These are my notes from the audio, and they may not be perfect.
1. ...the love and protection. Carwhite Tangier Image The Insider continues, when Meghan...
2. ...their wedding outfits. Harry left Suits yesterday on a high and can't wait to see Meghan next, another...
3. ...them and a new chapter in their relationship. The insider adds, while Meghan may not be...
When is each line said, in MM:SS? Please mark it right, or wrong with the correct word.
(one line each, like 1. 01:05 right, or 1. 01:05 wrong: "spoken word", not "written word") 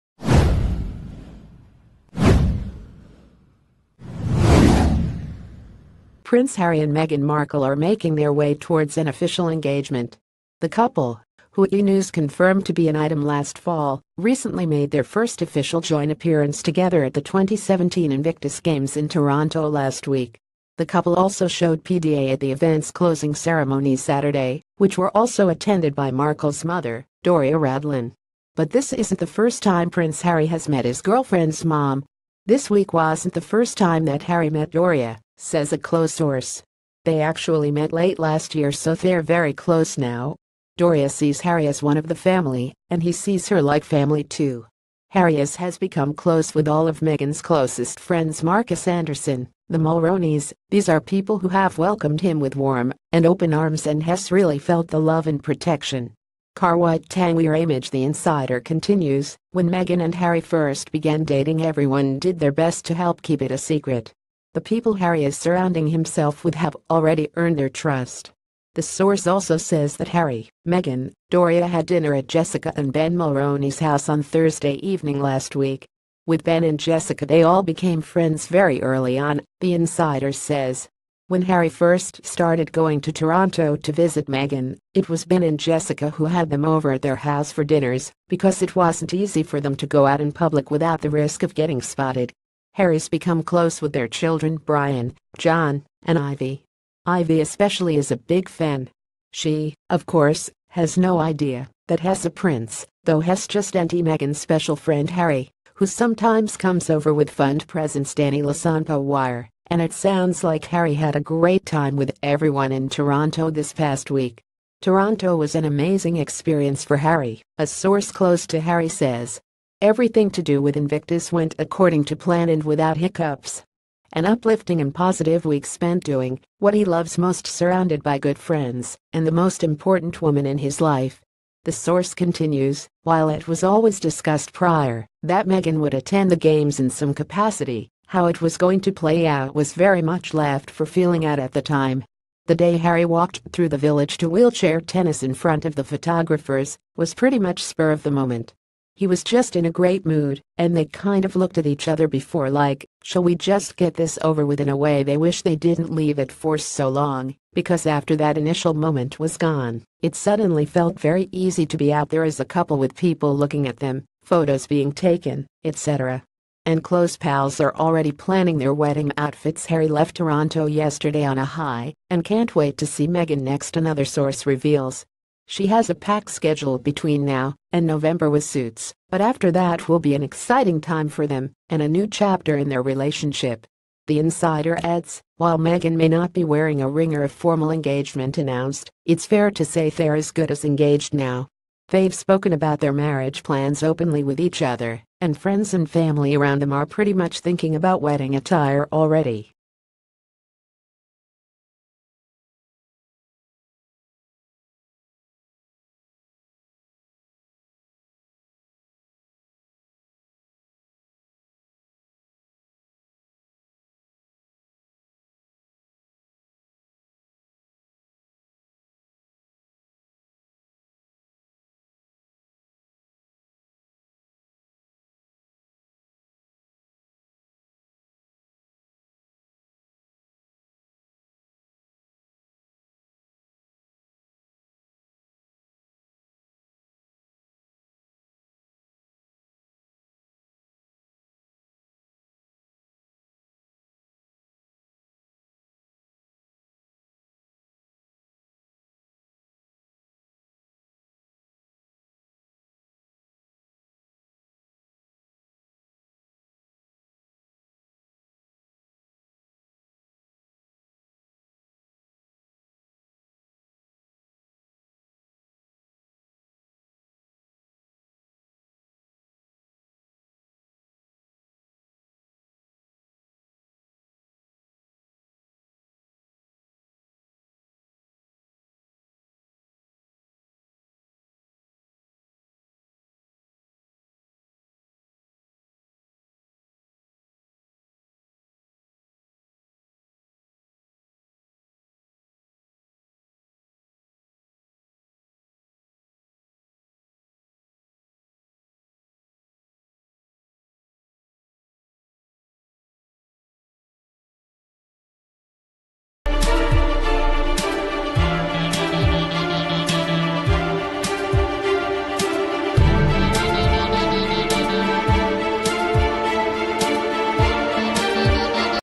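1. 00:54 right
2. 02:48 wrong: "Toronto", not "Suits"
3. 03:01 right.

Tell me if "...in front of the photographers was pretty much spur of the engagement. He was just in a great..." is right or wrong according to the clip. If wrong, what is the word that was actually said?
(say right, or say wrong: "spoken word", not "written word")
wrong: "moment", not "engagement".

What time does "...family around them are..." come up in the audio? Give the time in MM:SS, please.
03:15.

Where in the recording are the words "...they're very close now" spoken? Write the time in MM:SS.
00:38.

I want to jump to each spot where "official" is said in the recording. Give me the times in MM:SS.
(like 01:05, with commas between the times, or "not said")
00:09, 00:15.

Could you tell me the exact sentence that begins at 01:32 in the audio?
Harry's become close with their children Brian, John, and Ivy.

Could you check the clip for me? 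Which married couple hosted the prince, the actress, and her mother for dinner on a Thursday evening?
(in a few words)
Jessica and Ben Mulroney.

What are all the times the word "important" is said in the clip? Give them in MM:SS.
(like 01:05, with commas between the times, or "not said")
02:09.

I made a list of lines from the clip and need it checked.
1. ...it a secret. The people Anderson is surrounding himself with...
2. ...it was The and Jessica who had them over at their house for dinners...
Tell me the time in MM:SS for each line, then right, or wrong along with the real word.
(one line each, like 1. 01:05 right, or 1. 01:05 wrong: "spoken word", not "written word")
1. 01:03 wrong: "Harry", not "Anderson"
2. 01:24 wrong: "Ben", not "The".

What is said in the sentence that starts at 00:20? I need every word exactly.
The couple also showed PDA at the event's closing ceremony Saturday, which were also attended by Markle's mother, Doria Ragland.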